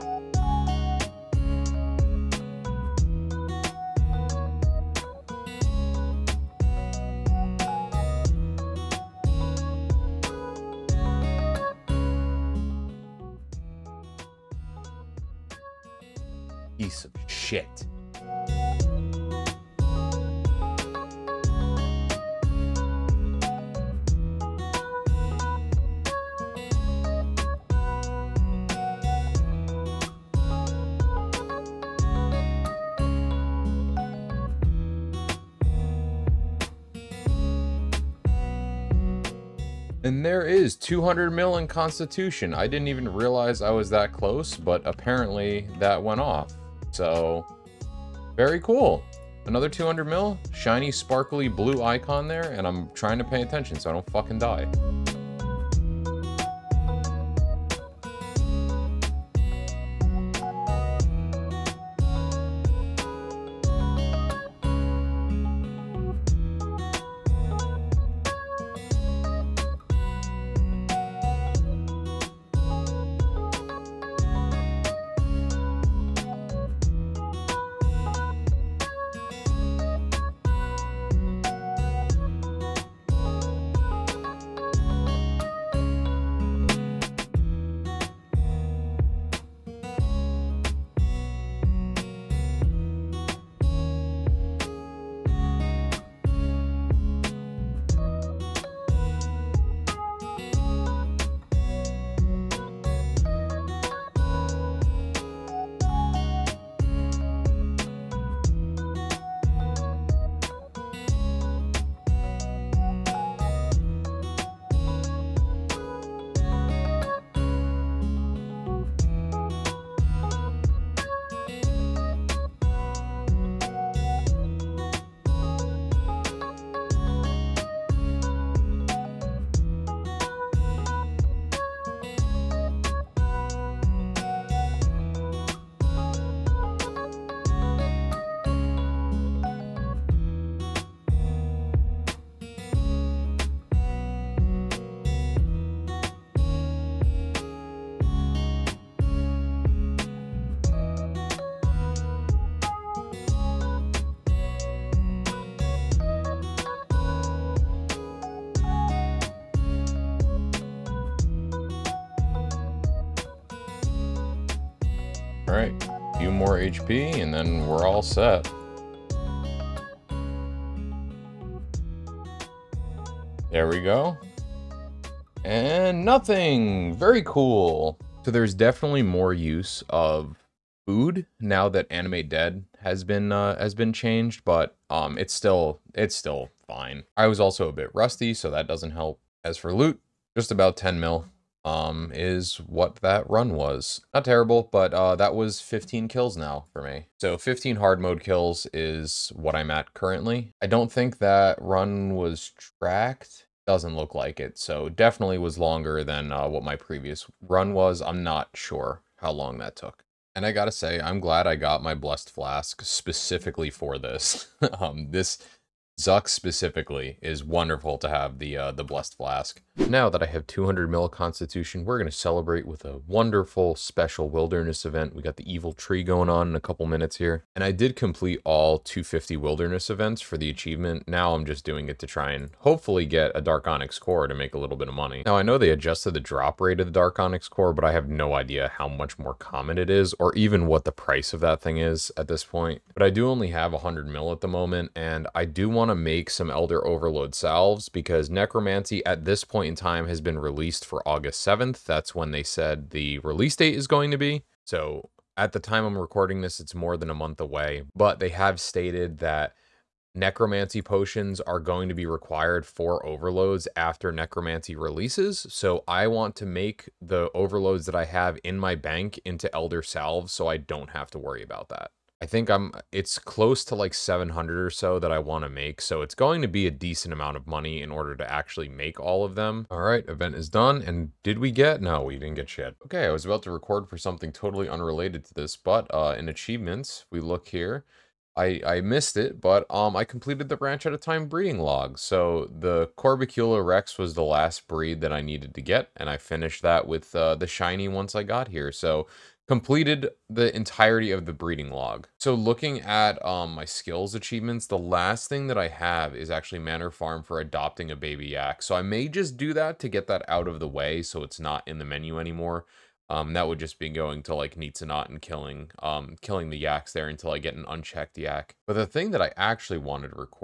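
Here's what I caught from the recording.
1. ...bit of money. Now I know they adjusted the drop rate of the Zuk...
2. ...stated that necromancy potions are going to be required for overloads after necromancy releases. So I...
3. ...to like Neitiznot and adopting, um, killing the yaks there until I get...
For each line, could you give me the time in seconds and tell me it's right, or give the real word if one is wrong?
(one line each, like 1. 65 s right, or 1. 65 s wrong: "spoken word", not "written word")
1. 234 s wrong: "Dark", not "Zuk"
2. 258 s right
3. 314 s wrong: "killing", not "adopting".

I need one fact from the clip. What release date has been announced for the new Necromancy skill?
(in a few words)
August 7th.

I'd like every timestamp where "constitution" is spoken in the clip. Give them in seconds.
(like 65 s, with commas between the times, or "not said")
41 s, 221 s.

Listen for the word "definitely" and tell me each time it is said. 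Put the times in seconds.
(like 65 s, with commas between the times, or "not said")
178 s, 204 s.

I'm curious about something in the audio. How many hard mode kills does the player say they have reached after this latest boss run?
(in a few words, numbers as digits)
15.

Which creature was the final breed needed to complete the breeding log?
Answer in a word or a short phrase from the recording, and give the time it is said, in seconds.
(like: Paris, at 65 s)
Corbicula Rex, at 292 s.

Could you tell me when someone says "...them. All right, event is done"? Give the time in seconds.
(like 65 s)
279 s.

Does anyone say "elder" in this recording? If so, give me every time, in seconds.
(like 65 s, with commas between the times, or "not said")
246 s, 269 s.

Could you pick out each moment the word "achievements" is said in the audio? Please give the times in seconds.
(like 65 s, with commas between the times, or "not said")
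230 s, 286 s, 304 s.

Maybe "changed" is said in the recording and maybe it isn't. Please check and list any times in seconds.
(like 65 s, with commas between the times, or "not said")
183 s.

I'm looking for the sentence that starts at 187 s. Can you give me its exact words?
I was also a bit rusty, so that doesn't help.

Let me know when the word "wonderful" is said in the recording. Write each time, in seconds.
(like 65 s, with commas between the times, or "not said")
217 s, 222 s.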